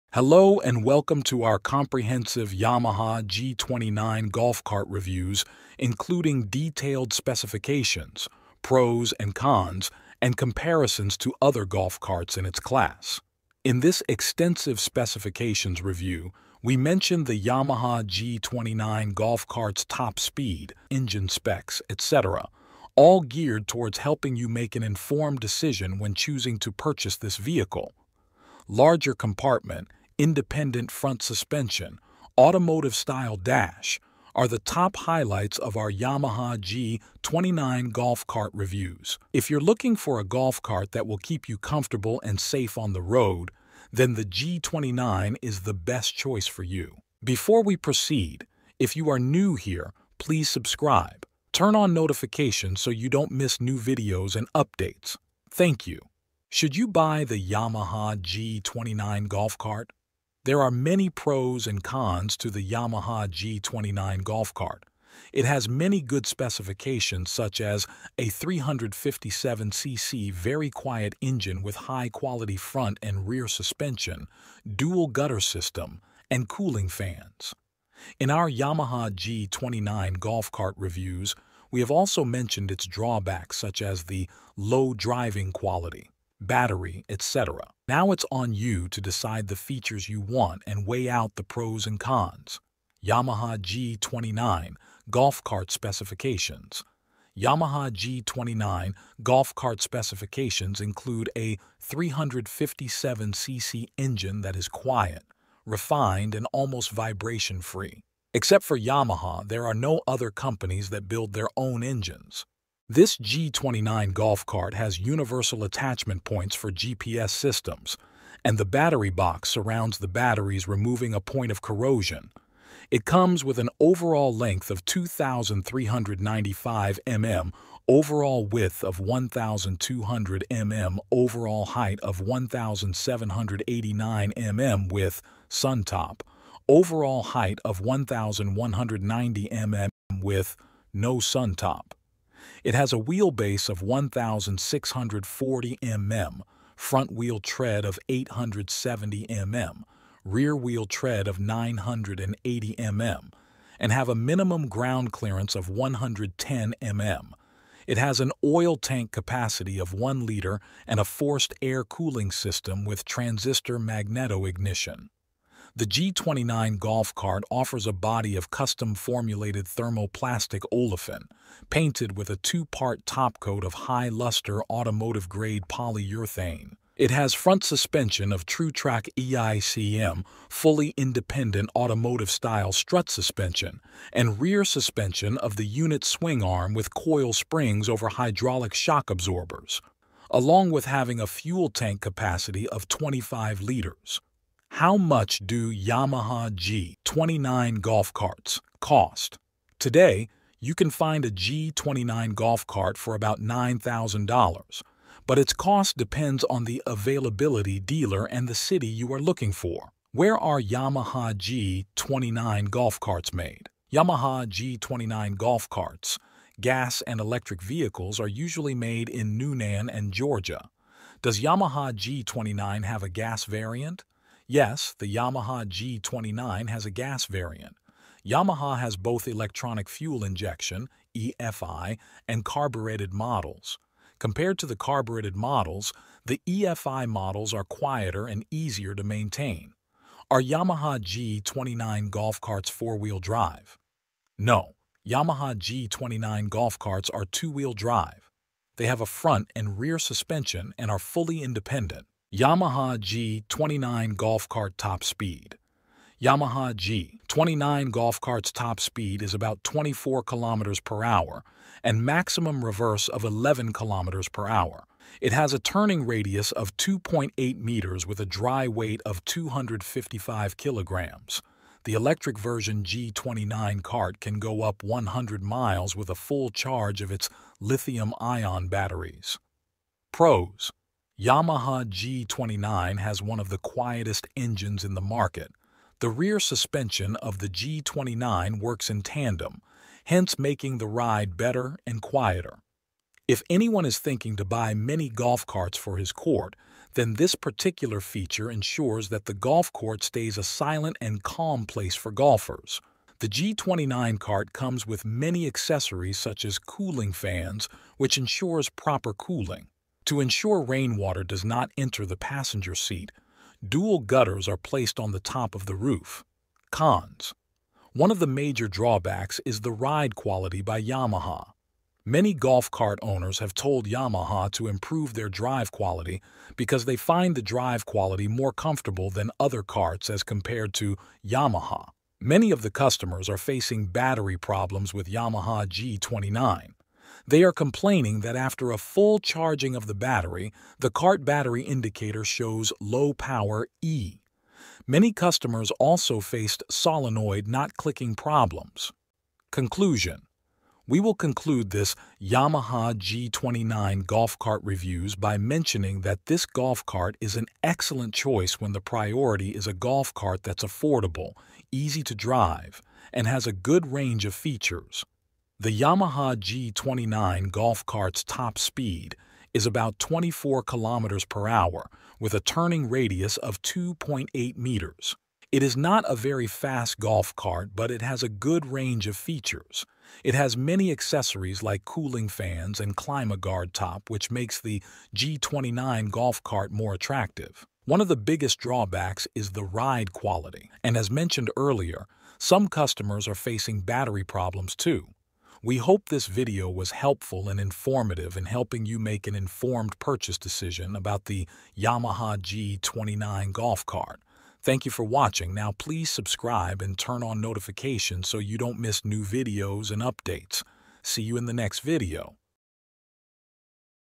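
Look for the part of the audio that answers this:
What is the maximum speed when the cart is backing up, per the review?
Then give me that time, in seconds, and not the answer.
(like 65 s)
263 s.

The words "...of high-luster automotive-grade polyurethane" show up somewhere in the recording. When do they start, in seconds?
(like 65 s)
173 s.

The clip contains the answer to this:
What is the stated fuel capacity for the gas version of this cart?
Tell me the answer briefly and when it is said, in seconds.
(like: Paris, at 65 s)
25 liters, at 192 s.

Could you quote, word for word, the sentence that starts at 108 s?
Except for Yamaha, there are no other companies that build their own engines.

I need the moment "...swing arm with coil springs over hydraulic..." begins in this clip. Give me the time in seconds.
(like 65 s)
186 s.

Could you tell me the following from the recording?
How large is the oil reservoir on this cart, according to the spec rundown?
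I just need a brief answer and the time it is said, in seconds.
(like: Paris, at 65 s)
1 liter, at 159 s.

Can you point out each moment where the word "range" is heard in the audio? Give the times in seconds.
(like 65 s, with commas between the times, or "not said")
363 s, 378 s.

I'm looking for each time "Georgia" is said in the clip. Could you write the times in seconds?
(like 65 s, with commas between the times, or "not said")
220 s.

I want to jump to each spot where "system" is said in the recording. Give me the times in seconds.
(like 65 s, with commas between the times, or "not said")
75 s, 117 s, 162 s.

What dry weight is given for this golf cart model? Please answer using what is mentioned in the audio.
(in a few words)
255 kg.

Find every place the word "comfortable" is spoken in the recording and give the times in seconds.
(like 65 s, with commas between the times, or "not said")
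41 s, 328 s.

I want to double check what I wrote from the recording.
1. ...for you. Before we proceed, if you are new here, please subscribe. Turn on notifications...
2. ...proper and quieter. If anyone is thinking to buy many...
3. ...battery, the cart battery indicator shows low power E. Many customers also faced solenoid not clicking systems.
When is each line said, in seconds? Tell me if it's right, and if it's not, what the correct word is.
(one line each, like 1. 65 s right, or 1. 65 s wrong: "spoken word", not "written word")
1. 46 s right
2. 291 s wrong: "better", not "proper"
3. 339 s wrong: "problems", not "systems".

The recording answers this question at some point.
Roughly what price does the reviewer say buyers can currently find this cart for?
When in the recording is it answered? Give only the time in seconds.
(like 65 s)
203 s.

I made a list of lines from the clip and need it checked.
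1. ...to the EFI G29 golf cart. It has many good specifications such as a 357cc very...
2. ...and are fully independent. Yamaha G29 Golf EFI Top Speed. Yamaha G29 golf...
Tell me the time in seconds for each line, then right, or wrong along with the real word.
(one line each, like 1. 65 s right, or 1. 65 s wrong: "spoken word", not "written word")
1. 62 s wrong: "Yamaha", not "EFI"
2. 250 s wrong: "Cart", not "EFI".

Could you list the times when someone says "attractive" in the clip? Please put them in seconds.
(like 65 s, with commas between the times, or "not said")
386 s.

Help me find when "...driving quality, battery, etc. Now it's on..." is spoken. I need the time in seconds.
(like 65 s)
84 s.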